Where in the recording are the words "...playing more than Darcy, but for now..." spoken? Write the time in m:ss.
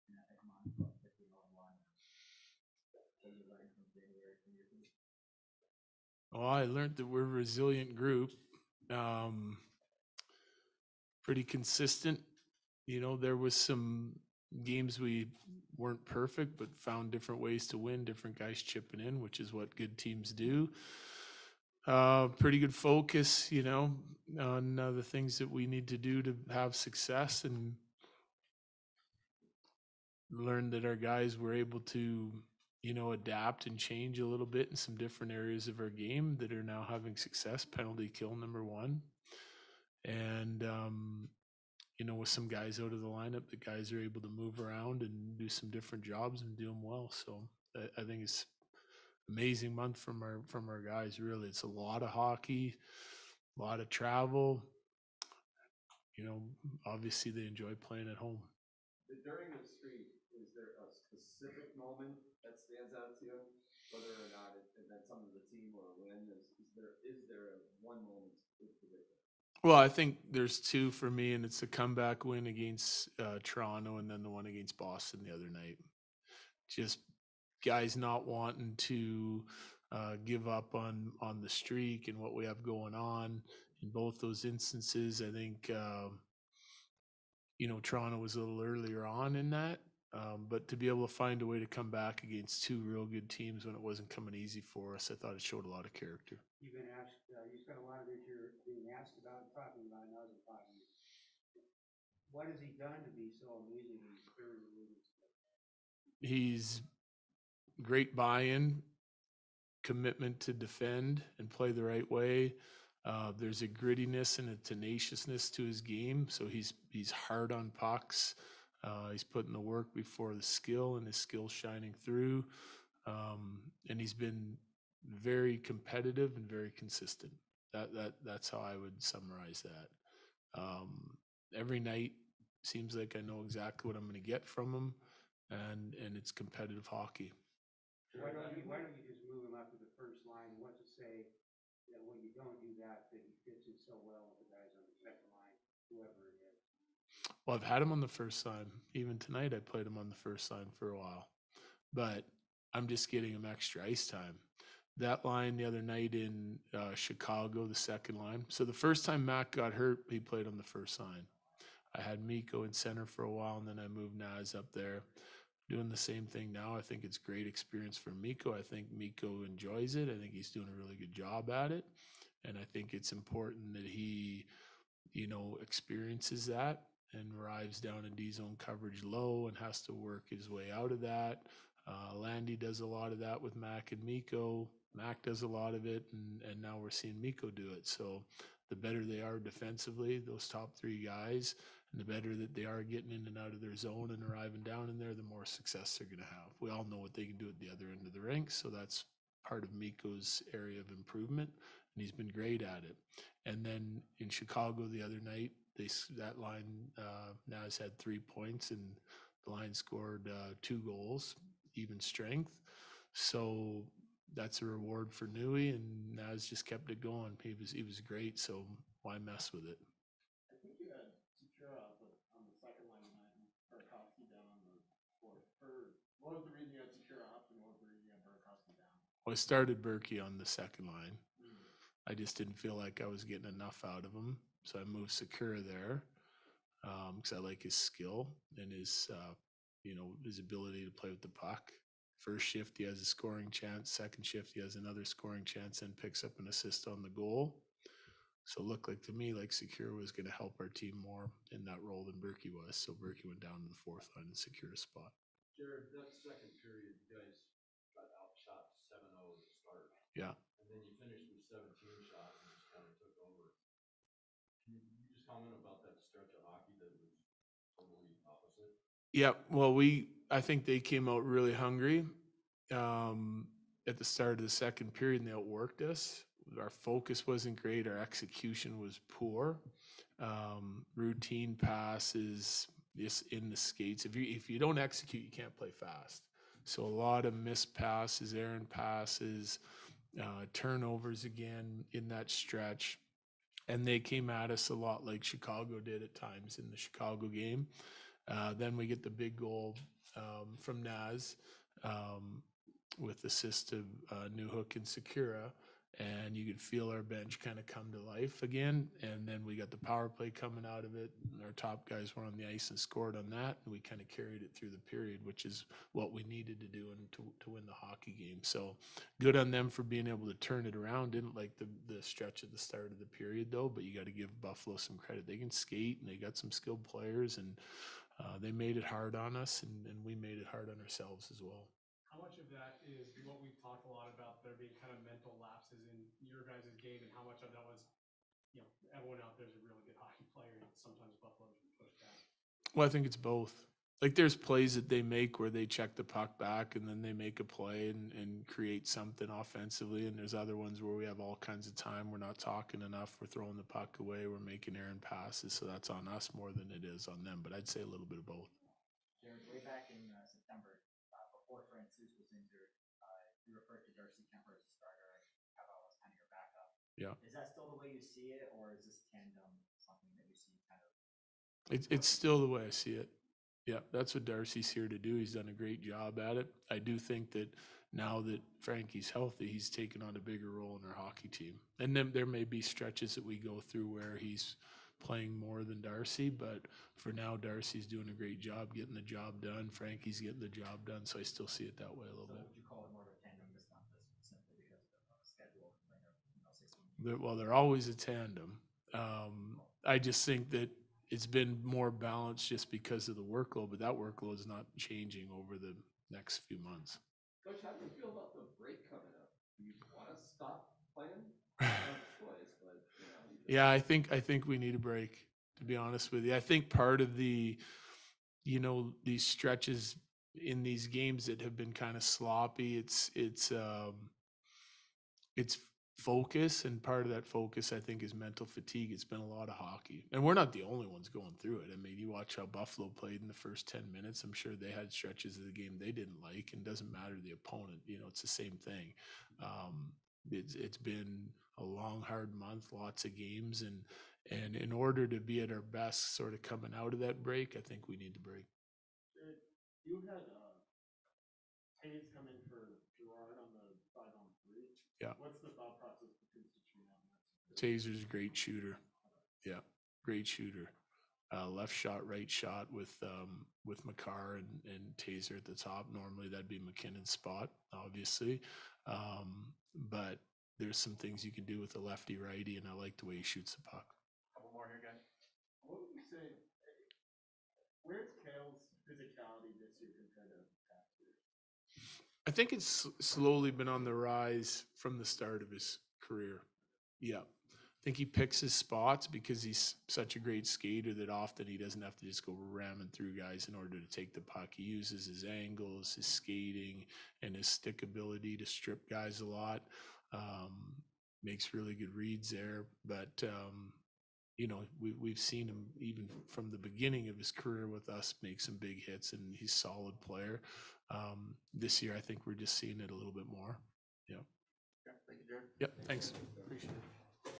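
6:24.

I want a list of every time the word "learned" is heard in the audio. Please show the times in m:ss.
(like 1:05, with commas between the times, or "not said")
0:06, 0:30.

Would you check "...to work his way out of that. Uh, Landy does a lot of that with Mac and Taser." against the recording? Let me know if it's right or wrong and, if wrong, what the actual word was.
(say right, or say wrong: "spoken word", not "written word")
wrong: "Mikko", not "Taser".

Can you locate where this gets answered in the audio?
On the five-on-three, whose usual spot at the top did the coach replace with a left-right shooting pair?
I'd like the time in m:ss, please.
7:46.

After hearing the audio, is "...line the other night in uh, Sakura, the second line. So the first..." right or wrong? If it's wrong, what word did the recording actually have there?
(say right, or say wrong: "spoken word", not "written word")
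wrong: "Chicago", not "Sakura".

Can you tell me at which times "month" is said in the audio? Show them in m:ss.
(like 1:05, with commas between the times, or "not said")
0:49, 6:46, 7:22.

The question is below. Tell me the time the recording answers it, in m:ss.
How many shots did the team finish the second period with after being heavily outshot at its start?
4:21.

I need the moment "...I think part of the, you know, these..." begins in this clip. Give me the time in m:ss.
6:56.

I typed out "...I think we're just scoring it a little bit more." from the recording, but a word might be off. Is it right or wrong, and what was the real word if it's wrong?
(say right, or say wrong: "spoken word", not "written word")
wrong: "seeing", not "scoring".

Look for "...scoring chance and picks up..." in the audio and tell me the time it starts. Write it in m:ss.
4:05.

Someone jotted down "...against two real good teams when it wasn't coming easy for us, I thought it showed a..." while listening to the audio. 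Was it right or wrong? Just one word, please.
right.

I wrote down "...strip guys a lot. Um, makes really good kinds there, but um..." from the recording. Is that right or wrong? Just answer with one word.
wrong.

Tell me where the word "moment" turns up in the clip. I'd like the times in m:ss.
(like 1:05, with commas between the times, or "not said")
1:01, 1:08.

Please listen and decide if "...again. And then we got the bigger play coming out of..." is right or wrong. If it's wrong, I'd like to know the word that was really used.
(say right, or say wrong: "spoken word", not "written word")
wrong: "power", not "bigger".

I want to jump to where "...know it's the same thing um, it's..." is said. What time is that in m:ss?
7:17.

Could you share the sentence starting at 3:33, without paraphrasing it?
So that's a reward for Nui, and Naz just kept it going.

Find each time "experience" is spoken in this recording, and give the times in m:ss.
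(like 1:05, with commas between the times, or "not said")
2:47, 2:55.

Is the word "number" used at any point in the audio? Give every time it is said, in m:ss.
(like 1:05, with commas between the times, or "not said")
0:38.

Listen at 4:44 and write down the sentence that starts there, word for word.
If you if you don't execute, you can't play fast.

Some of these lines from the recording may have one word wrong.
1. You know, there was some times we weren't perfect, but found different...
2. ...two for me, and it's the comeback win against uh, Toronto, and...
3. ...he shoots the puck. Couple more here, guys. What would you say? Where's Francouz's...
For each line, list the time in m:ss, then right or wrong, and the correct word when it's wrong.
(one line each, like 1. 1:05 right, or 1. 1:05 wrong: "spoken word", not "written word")
1. 0:12 wrong: "games", not "times"
2. 1:10 right
3. 7:53 wrong: "Cale", not "Francouz".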